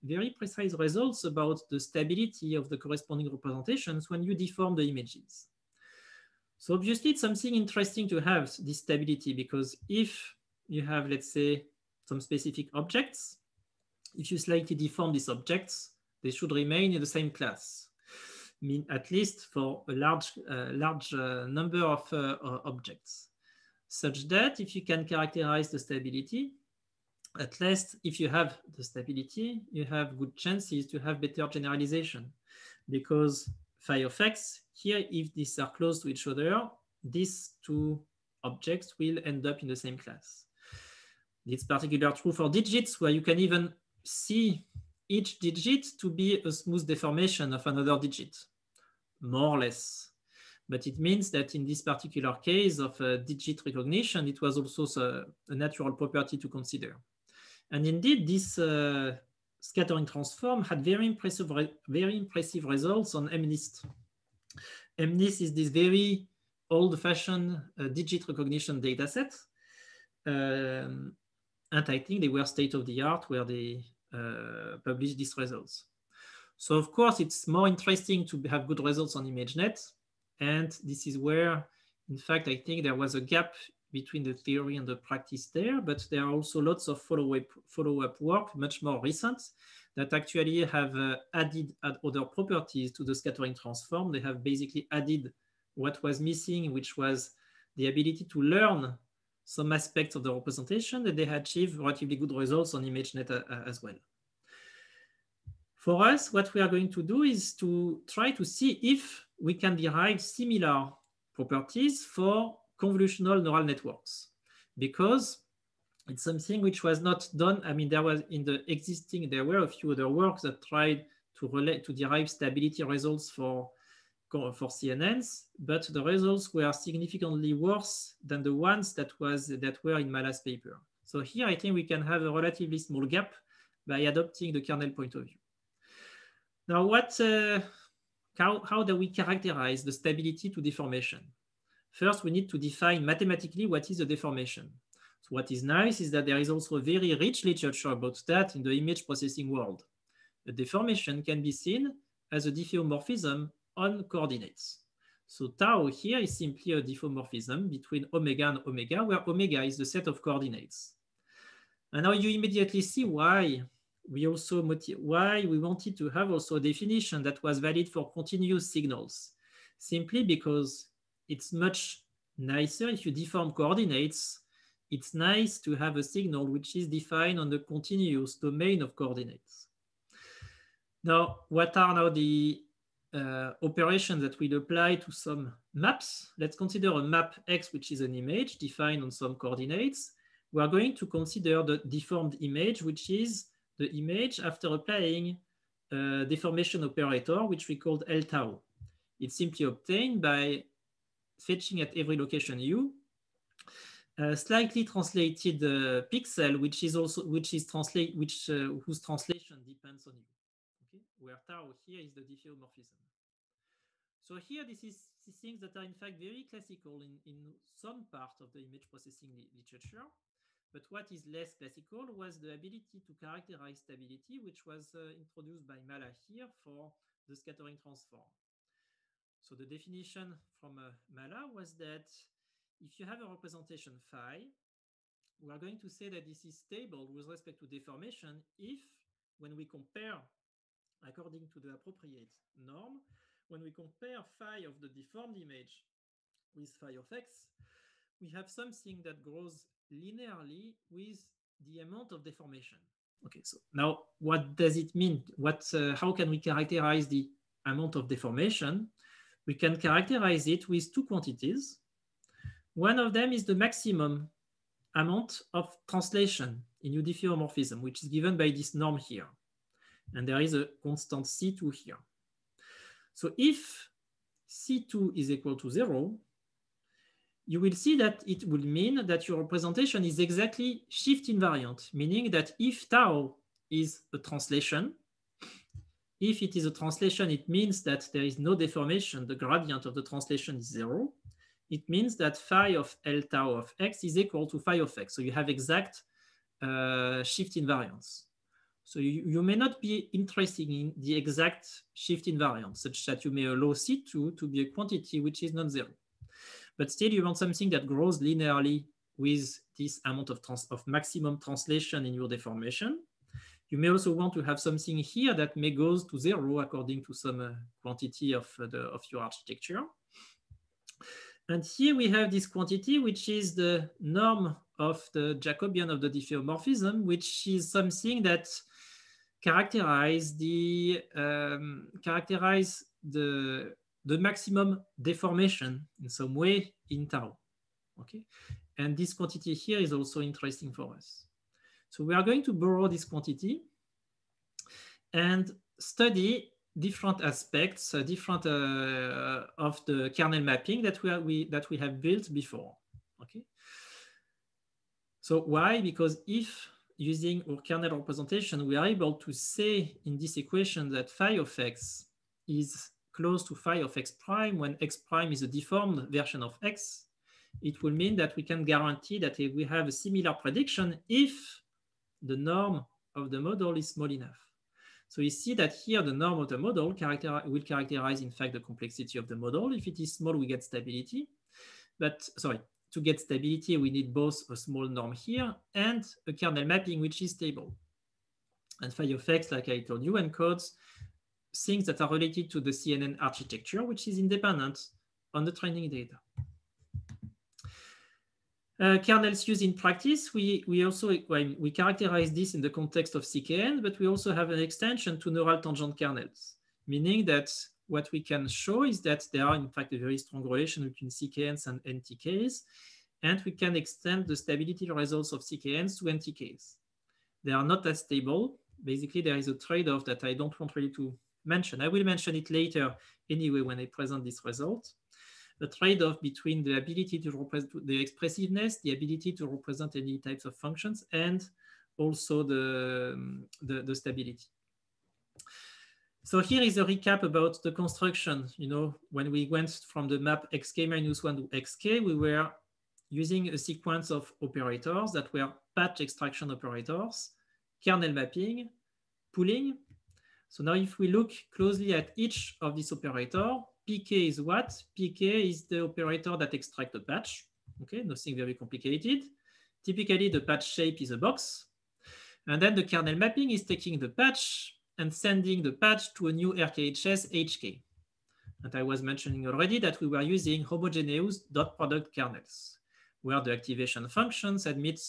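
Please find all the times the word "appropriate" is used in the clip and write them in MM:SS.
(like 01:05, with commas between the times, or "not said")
04:01.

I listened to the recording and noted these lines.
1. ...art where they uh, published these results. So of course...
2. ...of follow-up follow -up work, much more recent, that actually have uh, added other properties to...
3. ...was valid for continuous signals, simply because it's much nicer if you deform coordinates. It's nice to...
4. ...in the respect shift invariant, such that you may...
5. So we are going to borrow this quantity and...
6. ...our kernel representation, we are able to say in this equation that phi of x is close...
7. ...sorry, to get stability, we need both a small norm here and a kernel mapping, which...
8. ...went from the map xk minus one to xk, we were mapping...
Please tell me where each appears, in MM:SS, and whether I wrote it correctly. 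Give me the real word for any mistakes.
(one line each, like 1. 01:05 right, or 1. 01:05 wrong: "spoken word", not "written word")
1. 01:13 right
2. 01:26 right
3. 02:47 right
4. 05:00 wrong: "exact", not "respect"
5. 05:41 right
6. 05:57 right
7. 06:22 right
8. 07:19 wrong: "using", not "mapping".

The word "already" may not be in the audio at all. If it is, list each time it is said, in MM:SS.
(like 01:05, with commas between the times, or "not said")
07:49.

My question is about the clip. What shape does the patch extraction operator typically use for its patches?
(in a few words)
a box.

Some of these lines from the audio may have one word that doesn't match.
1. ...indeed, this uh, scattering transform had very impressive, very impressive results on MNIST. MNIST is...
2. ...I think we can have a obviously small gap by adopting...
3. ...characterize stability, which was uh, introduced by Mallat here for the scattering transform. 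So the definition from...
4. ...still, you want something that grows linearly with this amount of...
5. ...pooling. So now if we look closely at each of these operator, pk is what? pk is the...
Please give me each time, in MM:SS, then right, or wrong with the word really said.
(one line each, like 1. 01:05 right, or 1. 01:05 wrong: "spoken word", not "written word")
1. 00:57 right
2. 02:11 wrong: "relatively", not "obviously"
3. 03:43 right
4. 05:06 right
5. 07:29 right.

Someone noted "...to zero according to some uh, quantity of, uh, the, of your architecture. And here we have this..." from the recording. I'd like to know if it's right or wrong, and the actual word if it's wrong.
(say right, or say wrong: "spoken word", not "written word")
right.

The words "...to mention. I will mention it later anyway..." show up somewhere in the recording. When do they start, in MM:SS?
07:00.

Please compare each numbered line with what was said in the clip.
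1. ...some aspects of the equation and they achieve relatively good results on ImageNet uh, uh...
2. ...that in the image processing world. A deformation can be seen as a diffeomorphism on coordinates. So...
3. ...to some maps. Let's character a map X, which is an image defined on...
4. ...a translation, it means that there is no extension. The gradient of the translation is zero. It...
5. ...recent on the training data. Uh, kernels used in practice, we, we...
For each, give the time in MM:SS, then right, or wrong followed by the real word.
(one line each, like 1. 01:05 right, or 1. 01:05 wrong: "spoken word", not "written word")
1. 01:39 wrong: "representation", not "equation"
2. 02:28 right
3. 03:04 wrong: "consider", not "character"
4. 04:46 wrong: "deformation", not "extension"
5. 06:34 wrong: "independent", not "recent".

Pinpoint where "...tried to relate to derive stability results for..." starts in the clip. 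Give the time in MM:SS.
02:00.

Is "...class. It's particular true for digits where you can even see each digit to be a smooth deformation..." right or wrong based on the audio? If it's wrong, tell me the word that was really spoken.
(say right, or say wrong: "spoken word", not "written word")
right.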